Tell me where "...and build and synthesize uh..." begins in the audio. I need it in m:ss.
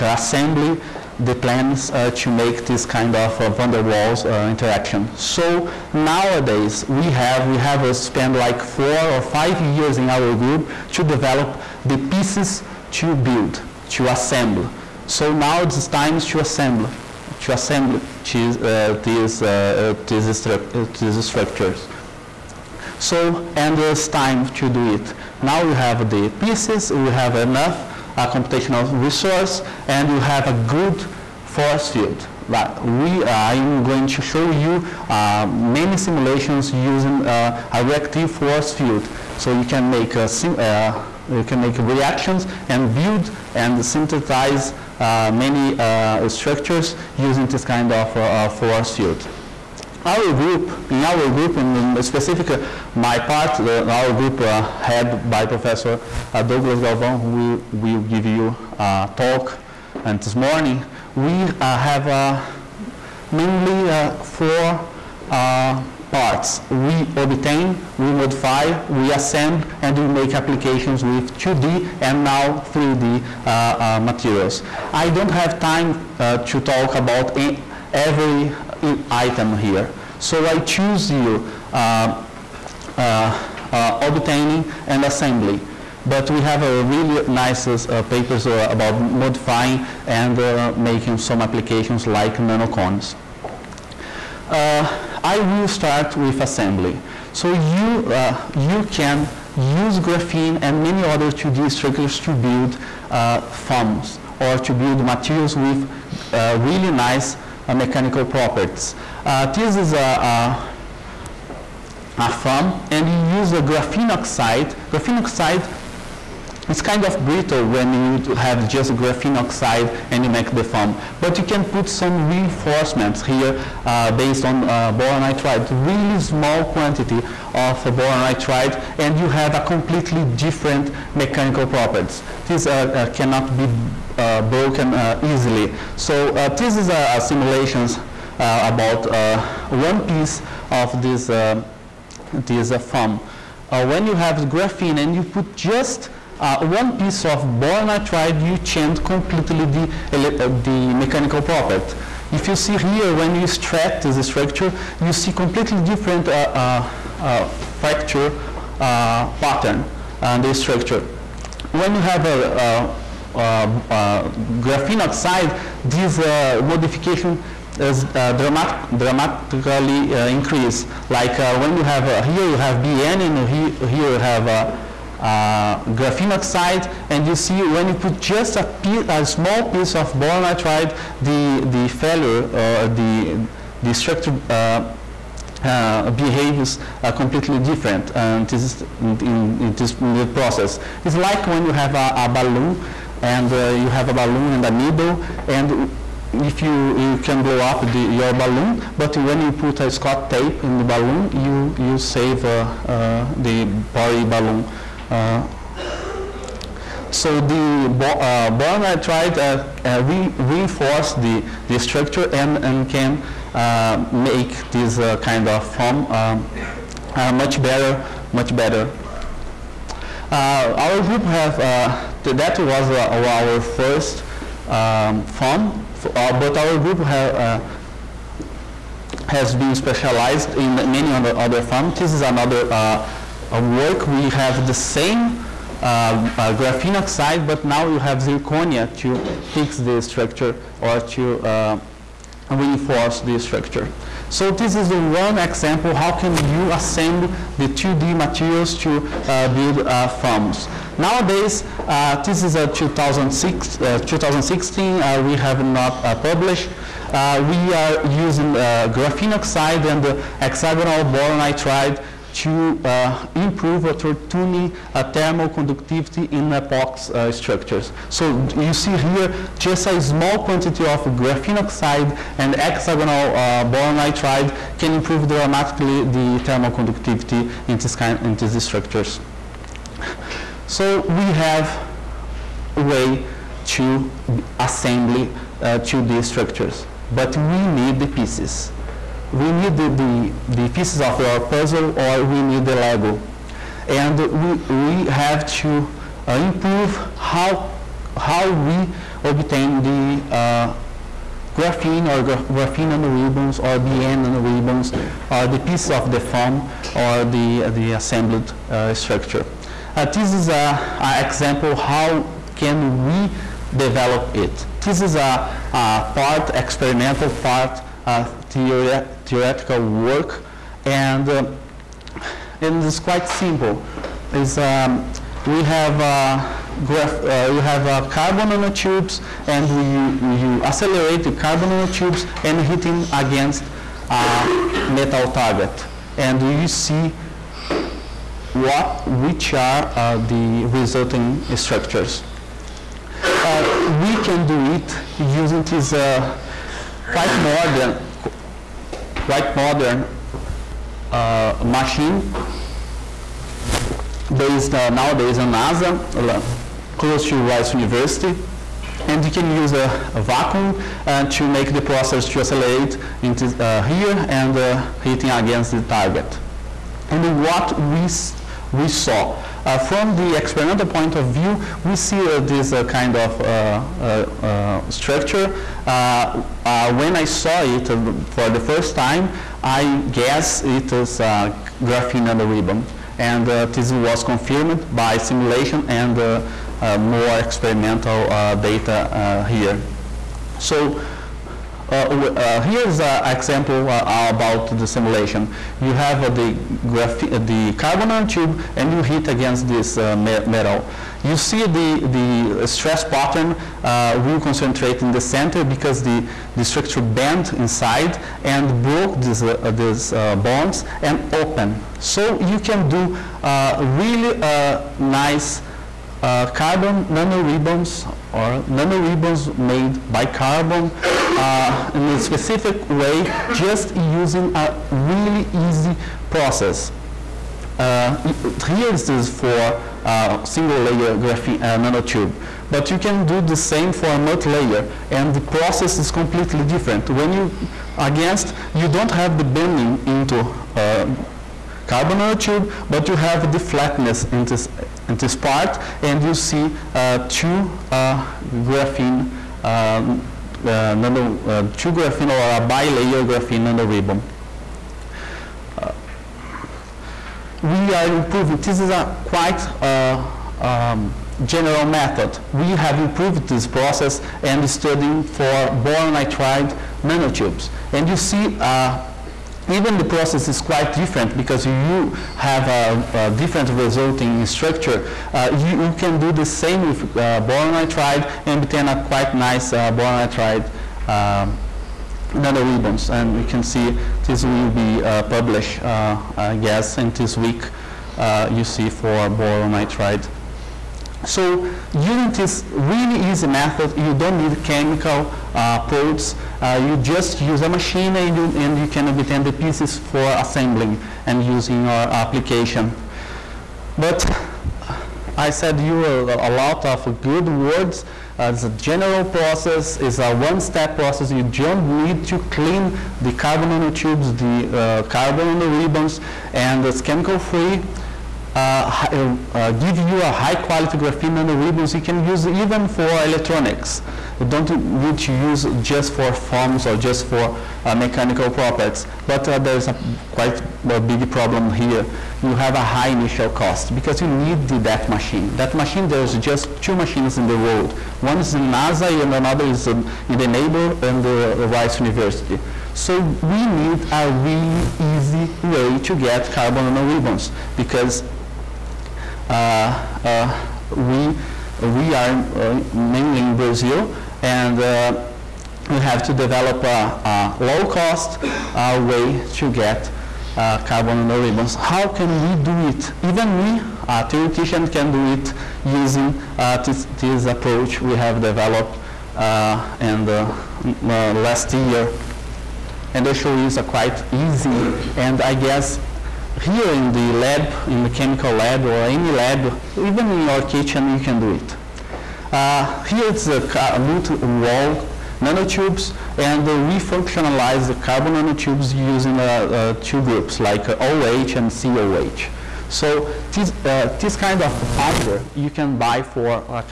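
0:42.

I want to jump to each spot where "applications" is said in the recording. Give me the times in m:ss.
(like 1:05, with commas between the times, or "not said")
1:10, 1:31, 8:22.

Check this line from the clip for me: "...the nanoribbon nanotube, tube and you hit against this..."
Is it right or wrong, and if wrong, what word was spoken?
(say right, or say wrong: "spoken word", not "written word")
wrong: "carbon", not "nanoribbon".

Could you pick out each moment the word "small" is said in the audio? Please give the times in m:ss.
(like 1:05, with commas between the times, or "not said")
2:06, 2:59, 4:29.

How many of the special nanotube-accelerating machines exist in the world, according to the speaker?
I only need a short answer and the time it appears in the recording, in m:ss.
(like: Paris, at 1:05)
2, at 8:56.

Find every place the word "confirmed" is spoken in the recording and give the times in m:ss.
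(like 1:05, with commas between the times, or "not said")
6:24.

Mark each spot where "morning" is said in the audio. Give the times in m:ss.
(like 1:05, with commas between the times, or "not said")
1:00.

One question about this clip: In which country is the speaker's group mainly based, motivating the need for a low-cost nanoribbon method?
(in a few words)
Brazil.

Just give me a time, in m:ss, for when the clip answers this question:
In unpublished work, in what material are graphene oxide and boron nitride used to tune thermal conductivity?
4:26.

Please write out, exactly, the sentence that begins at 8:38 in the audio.
Uh, uh, give you a high-quality graphene nanoribbons.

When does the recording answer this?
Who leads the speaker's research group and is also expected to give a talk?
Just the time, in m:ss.
0:56.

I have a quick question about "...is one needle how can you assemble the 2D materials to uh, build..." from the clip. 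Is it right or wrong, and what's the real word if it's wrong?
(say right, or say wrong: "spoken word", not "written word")
wrong: "example", not "needle".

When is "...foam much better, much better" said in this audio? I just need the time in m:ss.
3:35.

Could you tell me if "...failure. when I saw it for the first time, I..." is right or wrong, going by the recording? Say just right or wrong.
wrong.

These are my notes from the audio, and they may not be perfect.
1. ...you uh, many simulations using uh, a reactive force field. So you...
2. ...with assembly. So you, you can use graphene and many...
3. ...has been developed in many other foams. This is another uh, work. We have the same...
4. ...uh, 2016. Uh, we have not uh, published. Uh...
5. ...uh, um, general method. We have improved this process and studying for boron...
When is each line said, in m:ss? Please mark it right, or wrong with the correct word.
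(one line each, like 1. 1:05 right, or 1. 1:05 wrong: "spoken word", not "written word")
1. 0:34 right
2. 1:36 right
3. 3:49 wrong: "specialized", not "developed"
4. 4:13 right
5. 7:39 right.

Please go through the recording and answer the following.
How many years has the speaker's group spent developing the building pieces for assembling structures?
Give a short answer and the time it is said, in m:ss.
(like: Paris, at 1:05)
four or five years, at 0:08.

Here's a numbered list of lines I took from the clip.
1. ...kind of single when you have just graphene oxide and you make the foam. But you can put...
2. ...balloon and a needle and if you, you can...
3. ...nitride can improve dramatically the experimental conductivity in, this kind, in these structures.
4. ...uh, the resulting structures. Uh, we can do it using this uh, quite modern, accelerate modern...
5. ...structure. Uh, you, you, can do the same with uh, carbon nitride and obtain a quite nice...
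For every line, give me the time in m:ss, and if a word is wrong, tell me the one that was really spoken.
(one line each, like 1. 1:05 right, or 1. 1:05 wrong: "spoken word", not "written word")
1. 1:56 wrong: "brittle", not "single"
2. 3:14 right
3. 4:33 wrong: "thermal", not "experimental"
4. 5:39 wrong: "quite", not "accelerate"
5. 7:54 wrong: "boron", not "carbon".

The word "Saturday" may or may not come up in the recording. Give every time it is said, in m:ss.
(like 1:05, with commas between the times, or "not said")
not said.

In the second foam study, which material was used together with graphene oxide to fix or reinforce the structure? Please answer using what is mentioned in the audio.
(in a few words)
zirconia.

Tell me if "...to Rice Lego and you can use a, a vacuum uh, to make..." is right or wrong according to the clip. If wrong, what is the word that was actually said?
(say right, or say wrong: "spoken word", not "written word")
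wrong: "University", not "Lego".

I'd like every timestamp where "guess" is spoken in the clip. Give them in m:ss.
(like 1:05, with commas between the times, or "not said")
6:20, 8:06, 9:35.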